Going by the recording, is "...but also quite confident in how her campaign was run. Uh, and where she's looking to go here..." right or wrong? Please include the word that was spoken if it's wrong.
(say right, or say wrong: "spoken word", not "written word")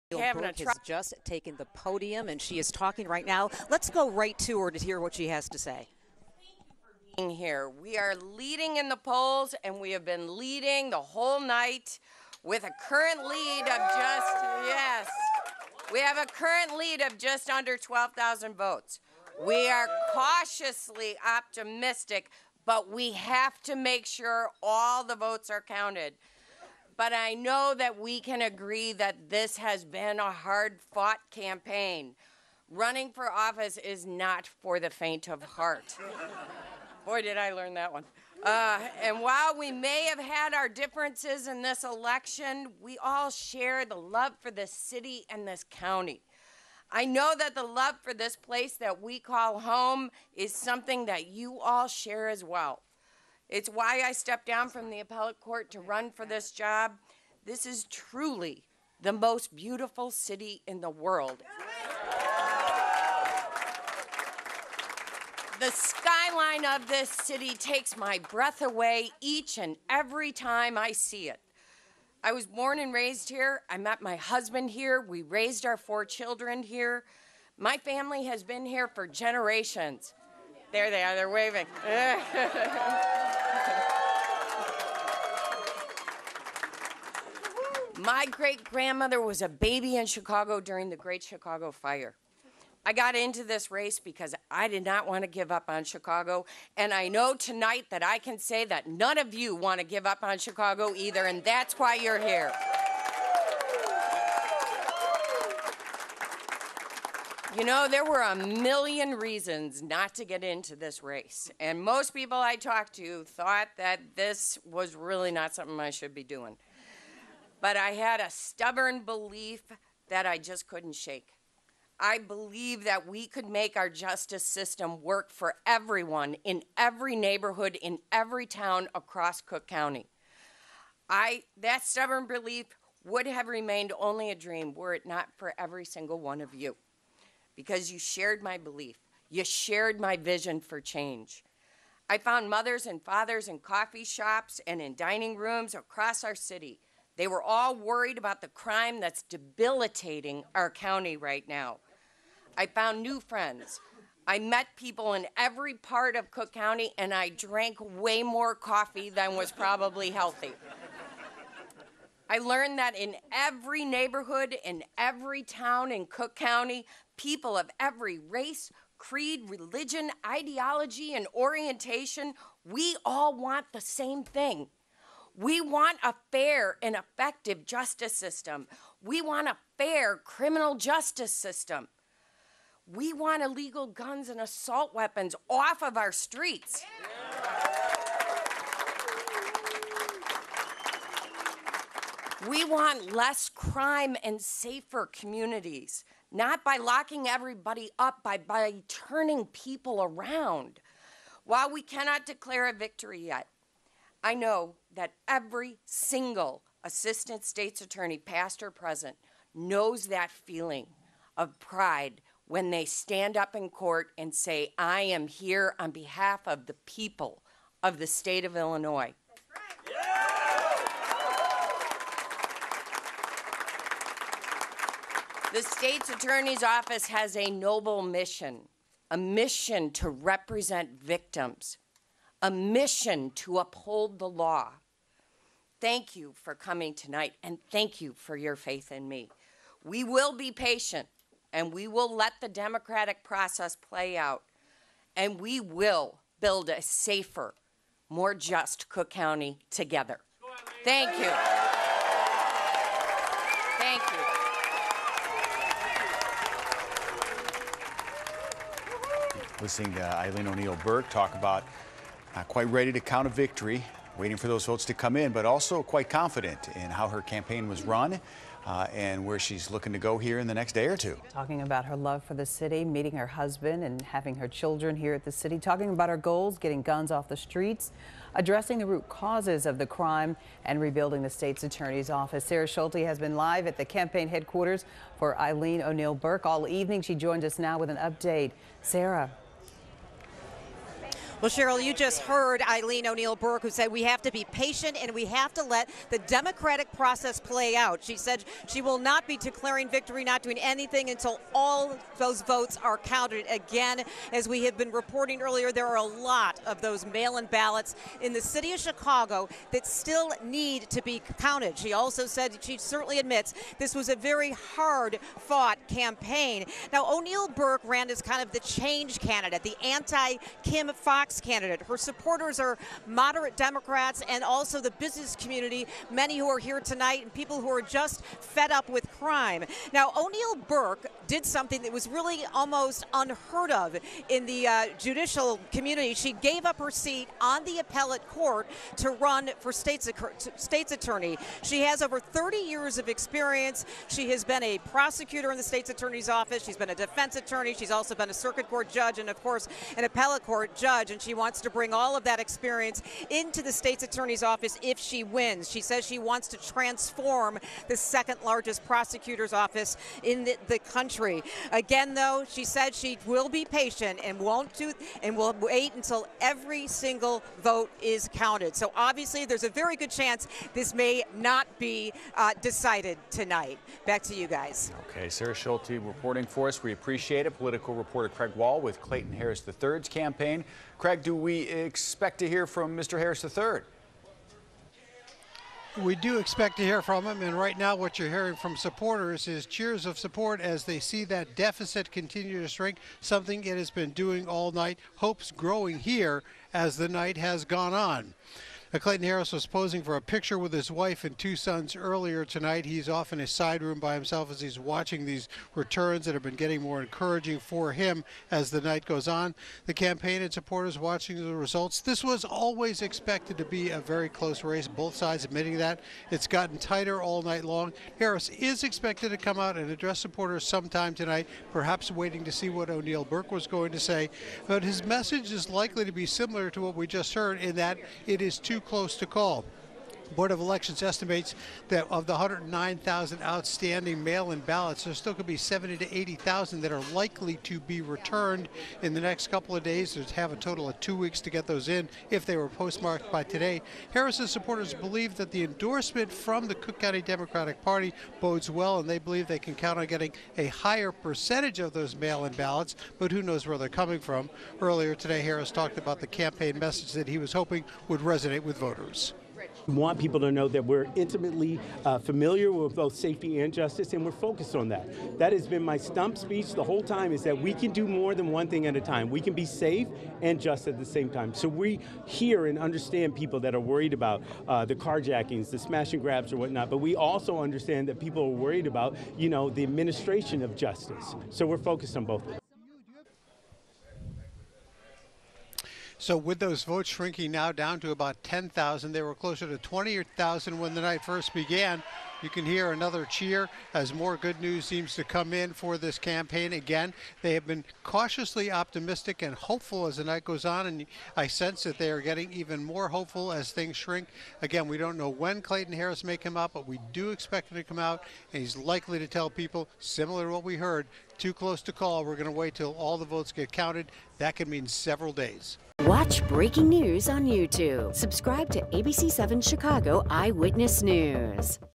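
right.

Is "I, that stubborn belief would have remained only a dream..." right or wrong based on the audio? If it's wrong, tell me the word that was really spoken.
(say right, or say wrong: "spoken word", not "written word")
right.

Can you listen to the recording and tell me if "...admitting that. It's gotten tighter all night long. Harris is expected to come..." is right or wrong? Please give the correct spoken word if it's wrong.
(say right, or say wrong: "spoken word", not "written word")
right.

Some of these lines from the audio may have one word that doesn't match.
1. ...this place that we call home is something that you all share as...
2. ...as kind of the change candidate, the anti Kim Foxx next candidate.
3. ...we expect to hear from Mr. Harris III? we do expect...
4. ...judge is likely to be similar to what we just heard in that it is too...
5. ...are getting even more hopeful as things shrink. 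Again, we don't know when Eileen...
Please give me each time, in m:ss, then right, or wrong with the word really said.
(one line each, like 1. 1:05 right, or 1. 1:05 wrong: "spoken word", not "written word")
1. 0:48 right
2. 5:18 right
3. 6:21 right
4. 7:05 wrong: "message", not "judge"
5. 8:22 wrong: "Clayton", not "Eileen".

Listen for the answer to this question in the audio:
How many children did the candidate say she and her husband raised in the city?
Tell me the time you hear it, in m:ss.
1:15.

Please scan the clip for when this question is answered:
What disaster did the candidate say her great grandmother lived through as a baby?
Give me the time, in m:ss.
1:30.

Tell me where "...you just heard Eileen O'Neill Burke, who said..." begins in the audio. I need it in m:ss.
4:51.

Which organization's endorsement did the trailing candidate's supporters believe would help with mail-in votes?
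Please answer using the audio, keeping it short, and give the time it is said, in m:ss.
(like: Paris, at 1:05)
Cook County Democratic Party, at 7:26.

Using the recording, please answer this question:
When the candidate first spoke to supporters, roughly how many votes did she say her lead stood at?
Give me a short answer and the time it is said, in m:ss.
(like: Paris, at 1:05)
just under 12,000, at 0:17.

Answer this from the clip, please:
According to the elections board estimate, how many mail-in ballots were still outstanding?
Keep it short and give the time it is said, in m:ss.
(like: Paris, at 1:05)
109,000, at 7:12.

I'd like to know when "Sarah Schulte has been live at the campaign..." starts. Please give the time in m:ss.
4:42.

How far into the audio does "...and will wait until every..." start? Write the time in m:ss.
6:05.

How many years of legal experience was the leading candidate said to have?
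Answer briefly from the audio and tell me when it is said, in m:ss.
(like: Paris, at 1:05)
over 30, at 5:42.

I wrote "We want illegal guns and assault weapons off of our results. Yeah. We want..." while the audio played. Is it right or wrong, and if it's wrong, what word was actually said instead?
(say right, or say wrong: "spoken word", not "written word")
wrong: "streets", not "results".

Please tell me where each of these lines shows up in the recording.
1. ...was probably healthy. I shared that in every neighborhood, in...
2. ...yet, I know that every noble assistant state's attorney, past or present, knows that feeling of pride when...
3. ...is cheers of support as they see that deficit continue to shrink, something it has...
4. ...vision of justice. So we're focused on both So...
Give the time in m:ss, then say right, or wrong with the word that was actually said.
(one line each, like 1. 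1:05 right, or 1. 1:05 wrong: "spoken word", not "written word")
1. 2:39 wrong: "learned", not "shared"
2. 3:23 wrong: "single", not "noble"
3. 6:29 right
4. 7:59 wrong: "administration", not "vision".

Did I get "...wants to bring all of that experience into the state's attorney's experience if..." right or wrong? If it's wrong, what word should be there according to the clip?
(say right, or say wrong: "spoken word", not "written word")
wrong: "office", not "experience".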